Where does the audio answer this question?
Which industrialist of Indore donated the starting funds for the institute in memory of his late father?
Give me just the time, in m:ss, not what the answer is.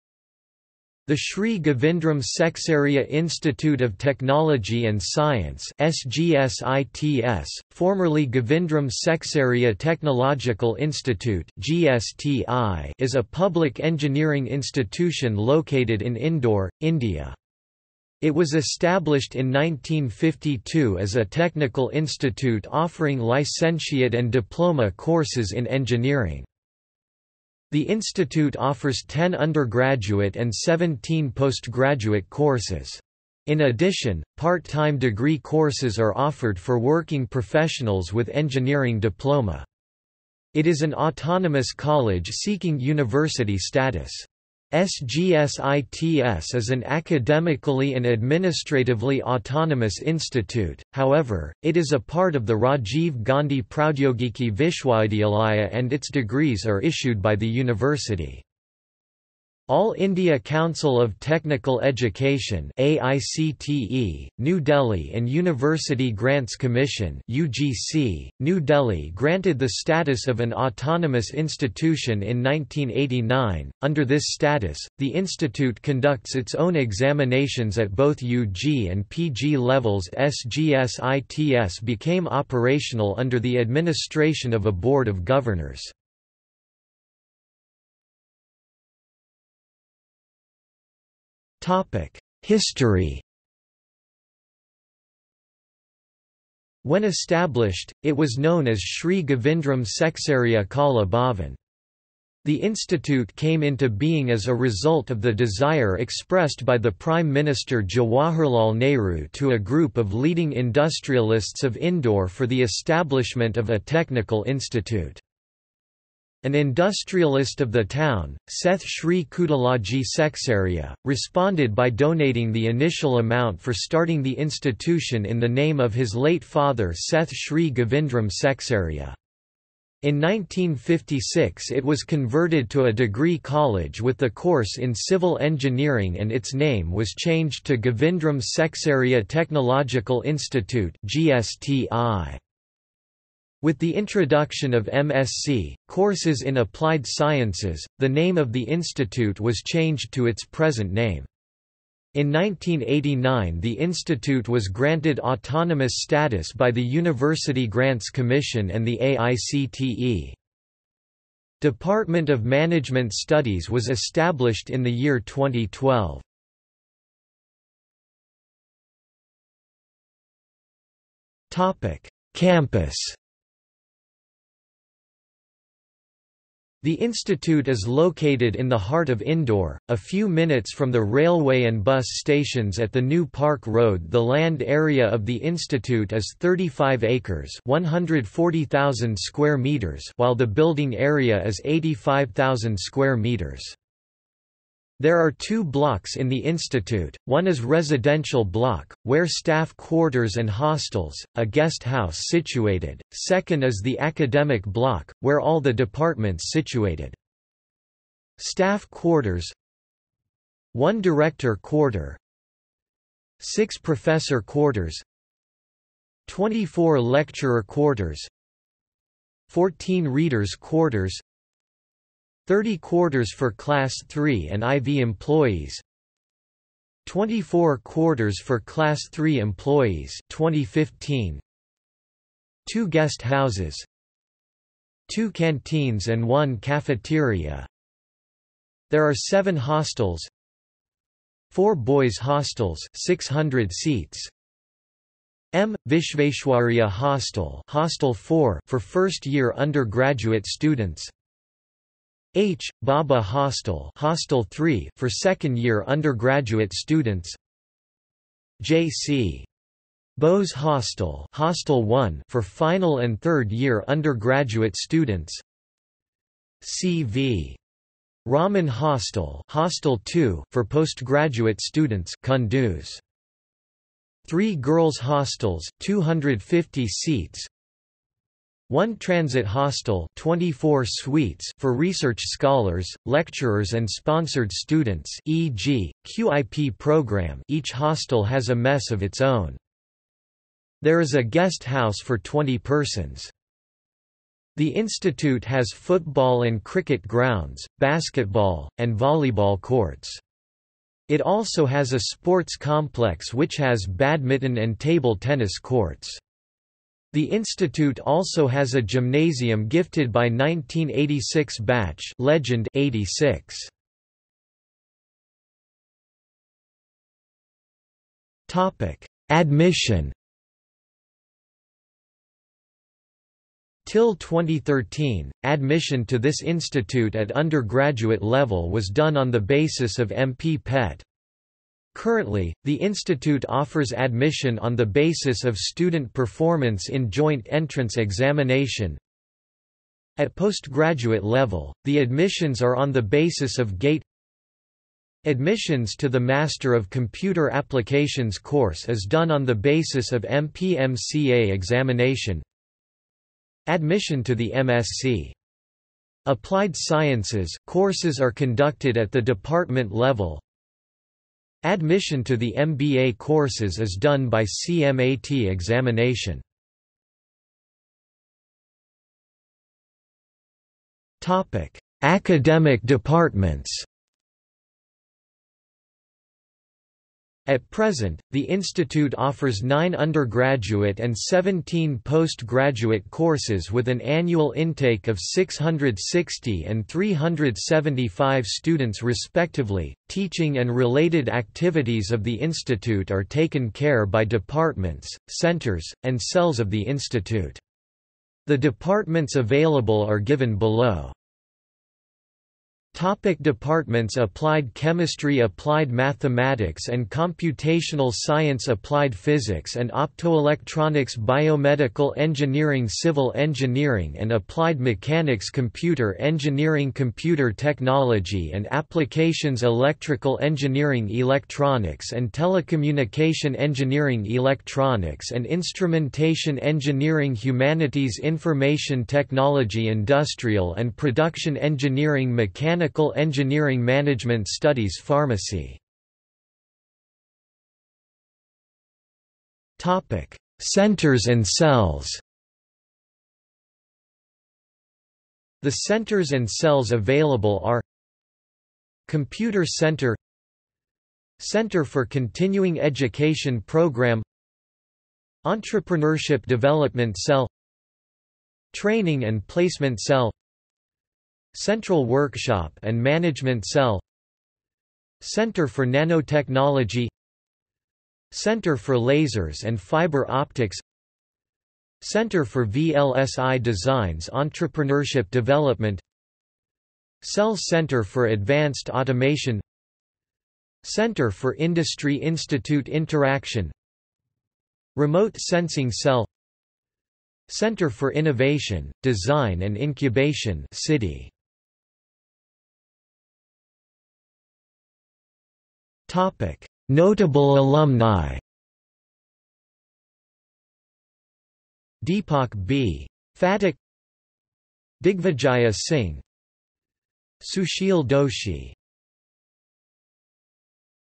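1:58.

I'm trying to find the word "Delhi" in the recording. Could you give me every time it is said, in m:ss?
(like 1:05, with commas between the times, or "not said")
1:04, 1:08.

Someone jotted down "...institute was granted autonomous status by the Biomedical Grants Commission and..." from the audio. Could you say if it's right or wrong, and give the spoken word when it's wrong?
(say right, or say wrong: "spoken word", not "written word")
wrong: "University", not "Biomedical".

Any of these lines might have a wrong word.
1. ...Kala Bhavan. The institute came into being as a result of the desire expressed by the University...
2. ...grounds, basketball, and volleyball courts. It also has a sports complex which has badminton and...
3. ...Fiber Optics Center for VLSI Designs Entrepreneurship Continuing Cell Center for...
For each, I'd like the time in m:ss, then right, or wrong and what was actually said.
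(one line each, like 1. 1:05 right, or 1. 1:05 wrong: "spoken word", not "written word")
1. 1:40 wrong: "Prime", not "University"
2. 4:57 right
3. 7:49 wrong: "Development", not "Continuing".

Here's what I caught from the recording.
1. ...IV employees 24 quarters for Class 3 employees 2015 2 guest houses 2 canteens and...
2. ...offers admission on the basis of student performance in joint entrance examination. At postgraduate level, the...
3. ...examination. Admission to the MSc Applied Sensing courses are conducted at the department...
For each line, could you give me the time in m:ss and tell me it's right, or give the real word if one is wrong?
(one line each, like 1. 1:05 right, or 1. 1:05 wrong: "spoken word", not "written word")
1. 3:44 right
2. 5:33 right
3. 5:51 wrong: "Sciences", not "Sensing".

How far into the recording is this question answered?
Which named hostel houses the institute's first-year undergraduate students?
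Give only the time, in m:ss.
4:05.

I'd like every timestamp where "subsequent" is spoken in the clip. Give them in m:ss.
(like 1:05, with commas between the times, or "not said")
not said.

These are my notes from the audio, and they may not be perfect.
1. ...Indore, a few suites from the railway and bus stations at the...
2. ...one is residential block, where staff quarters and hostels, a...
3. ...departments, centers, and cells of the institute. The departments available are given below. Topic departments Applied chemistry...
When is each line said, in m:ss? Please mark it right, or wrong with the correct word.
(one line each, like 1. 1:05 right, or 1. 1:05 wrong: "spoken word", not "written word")
1. 2:59 wrong: "minutes", not "suites"
2. 3:17 right
3. 6:34 right.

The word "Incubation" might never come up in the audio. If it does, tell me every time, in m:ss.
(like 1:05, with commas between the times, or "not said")
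8:09.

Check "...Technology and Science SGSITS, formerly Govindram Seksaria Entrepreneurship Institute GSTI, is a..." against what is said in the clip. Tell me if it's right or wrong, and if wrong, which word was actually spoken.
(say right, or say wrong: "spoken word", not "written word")
wrong: "Technological", not "Entrepreneurship".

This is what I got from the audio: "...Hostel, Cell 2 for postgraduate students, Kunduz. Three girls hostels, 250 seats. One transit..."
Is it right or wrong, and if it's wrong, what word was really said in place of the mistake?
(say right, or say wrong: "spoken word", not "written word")
wrong: "Hostel", not "Cell".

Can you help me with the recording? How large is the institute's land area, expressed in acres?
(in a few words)
35 acres.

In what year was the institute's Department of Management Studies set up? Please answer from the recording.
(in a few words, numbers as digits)
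2012.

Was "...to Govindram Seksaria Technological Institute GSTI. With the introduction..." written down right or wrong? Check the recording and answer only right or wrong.
right.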